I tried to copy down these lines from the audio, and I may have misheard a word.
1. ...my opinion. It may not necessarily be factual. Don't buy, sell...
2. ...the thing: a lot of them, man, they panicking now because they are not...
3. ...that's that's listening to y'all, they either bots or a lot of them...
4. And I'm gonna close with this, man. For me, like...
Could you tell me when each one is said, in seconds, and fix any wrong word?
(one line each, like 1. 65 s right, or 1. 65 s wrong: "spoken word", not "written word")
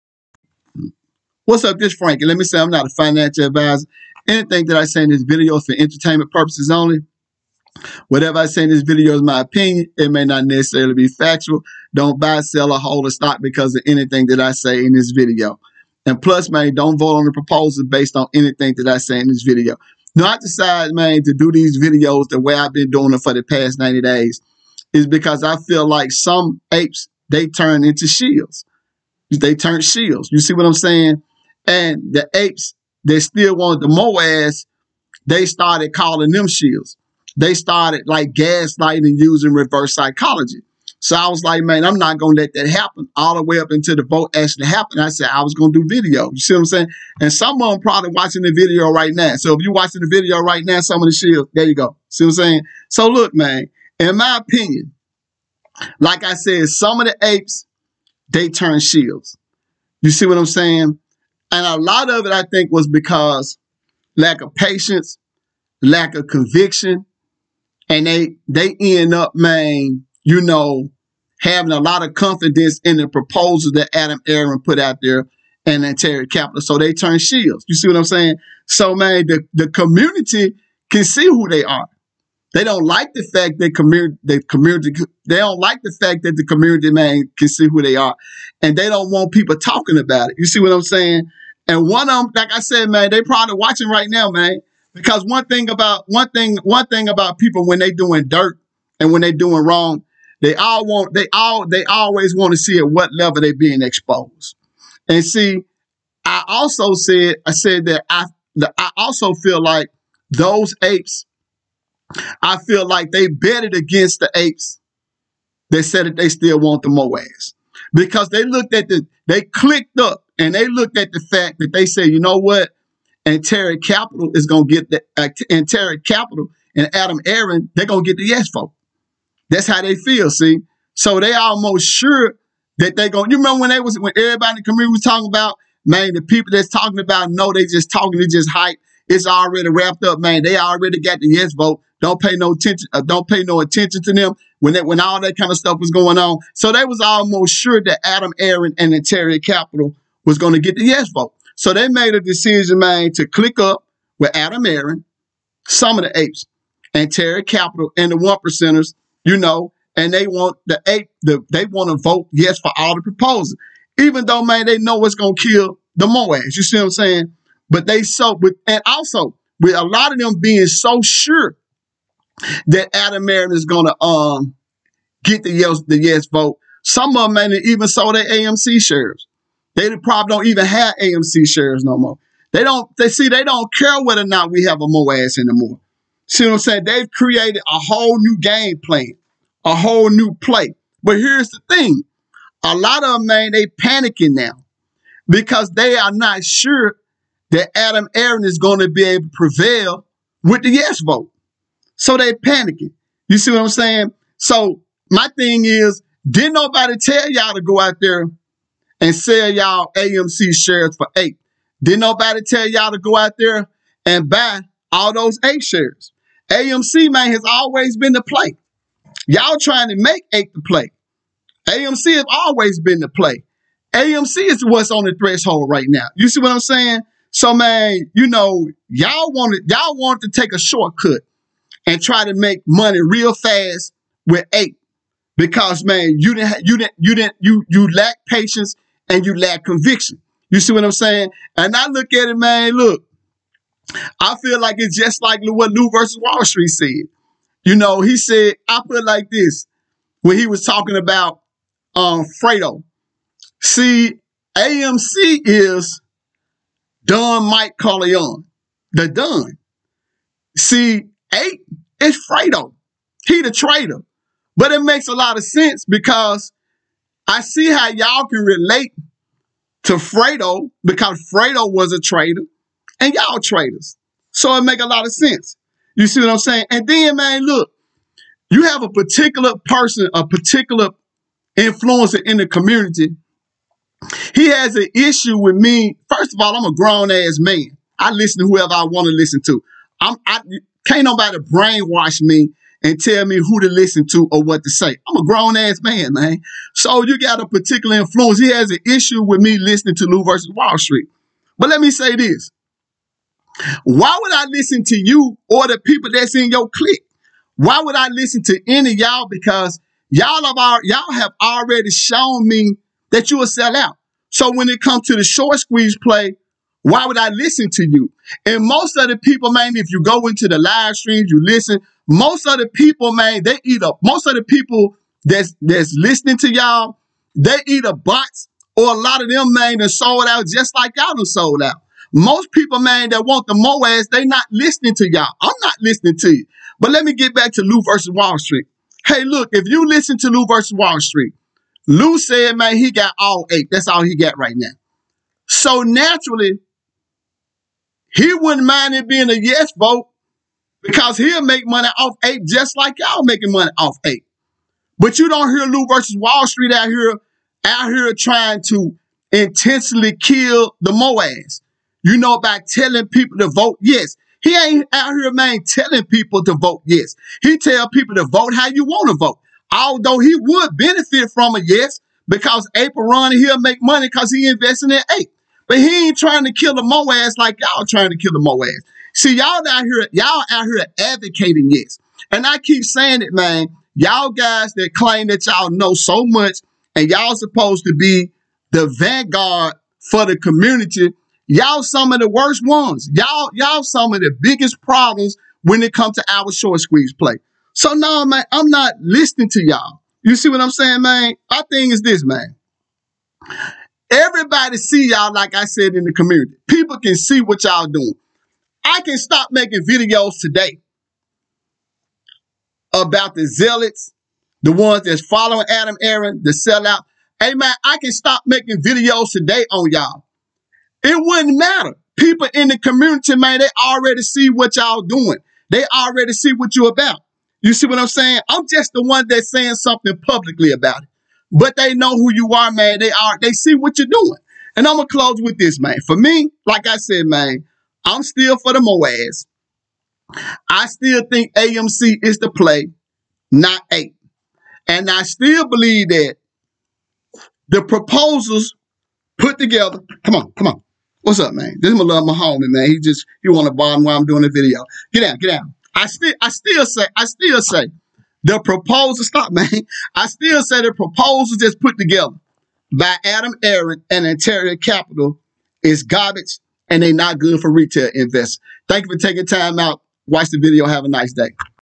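1. 9 s right
2. 191 s right
3. 325 s right
4. 434 s right.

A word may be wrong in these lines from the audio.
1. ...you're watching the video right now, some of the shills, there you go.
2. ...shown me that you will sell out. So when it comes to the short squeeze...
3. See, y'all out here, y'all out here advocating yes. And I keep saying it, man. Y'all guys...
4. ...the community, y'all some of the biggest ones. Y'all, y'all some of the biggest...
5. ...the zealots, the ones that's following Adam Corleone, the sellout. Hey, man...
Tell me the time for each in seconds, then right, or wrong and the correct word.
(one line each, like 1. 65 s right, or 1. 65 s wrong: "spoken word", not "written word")
1. 49 s right
2. 311 s right
3. 379 s right
4. 390 s wrong: "worst", not "biggest"
5. 413 s wrong: "Aron", not "Corleone".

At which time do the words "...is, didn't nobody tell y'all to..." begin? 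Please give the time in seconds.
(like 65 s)
205 s.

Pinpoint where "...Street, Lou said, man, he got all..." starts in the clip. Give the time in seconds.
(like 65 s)
340 s.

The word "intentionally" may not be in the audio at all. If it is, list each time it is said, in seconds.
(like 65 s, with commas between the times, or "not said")
359 s.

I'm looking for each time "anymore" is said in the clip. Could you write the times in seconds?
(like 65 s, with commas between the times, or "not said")
185 s.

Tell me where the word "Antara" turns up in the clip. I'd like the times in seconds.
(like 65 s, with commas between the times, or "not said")
123 s, 464 s.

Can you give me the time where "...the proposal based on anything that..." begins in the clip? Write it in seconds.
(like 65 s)
17 s.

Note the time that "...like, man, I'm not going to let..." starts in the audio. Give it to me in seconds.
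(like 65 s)
41 s.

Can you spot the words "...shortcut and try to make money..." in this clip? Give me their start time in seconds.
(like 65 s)
230 s.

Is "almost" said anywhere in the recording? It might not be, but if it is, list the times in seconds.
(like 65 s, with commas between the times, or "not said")
131 s, 147 s.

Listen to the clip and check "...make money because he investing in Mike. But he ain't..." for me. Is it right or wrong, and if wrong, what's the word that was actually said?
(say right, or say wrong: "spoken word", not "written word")
wrong: "Ape", not "Mike".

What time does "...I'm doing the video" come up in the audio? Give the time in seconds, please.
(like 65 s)
454 s.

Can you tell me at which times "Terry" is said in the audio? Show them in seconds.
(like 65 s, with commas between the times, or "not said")
75 s, 125 s, 149 s, 157 s.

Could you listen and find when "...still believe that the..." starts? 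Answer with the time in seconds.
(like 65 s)
445 s.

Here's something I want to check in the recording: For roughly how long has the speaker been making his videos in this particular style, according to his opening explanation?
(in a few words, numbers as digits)
90 days.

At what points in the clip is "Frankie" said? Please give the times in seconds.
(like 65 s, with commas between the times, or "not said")
1 s.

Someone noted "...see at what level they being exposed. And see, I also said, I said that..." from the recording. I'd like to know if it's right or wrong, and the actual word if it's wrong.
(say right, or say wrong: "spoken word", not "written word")
right.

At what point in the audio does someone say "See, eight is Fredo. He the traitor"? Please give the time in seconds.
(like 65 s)
260 s.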